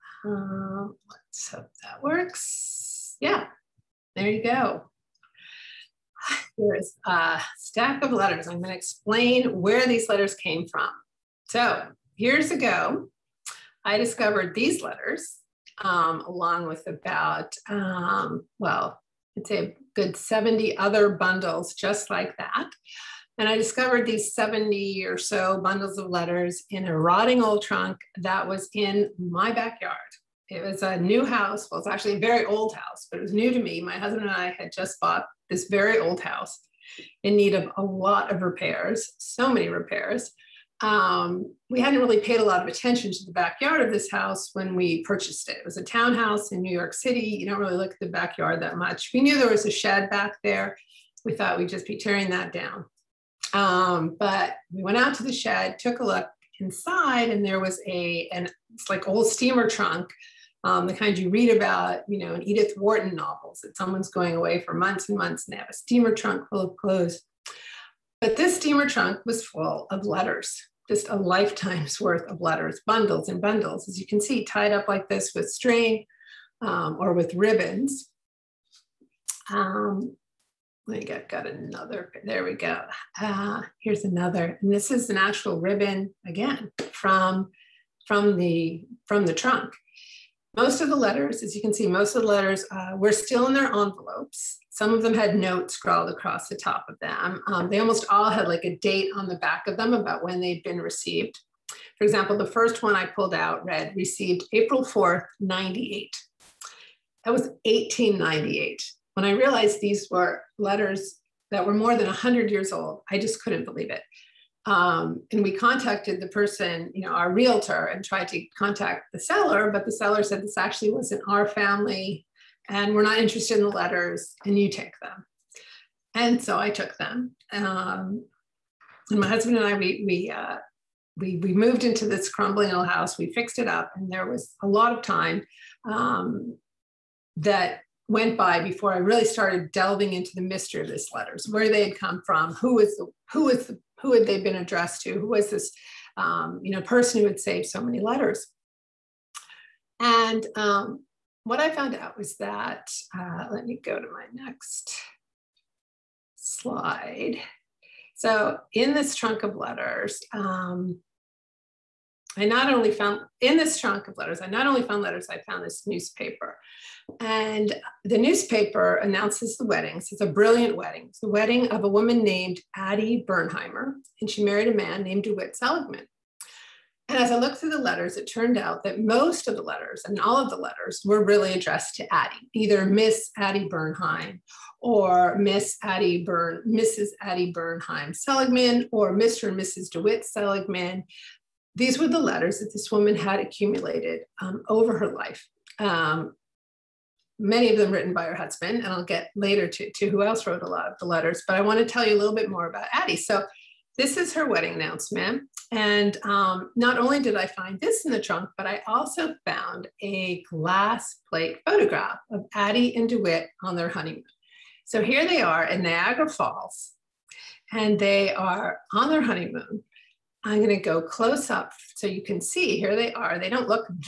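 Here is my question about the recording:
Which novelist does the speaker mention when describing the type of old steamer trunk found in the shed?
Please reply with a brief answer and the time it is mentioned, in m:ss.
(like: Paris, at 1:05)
Edith Wharton, at 1:02.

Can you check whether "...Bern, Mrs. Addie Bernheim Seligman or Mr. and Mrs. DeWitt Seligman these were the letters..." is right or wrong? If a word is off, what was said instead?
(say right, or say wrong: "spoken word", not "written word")
right.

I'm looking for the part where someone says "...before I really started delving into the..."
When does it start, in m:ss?
2:18.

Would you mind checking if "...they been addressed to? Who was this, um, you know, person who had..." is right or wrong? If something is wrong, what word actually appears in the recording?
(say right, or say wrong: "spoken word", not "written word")
right.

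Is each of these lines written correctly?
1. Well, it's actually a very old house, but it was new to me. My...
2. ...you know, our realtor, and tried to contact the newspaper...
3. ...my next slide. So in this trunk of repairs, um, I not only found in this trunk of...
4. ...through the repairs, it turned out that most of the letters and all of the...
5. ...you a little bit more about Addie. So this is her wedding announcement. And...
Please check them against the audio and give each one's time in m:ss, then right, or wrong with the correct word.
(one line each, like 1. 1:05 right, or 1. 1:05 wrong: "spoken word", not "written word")
1. 0:31 right
2. 1:56 wrong: "seller", not "newspaper"
3. 2:34 wrong: "letters", not "repairs"
4. 2:57 wrong: "letters", not "repairs"
5. 3:22 right.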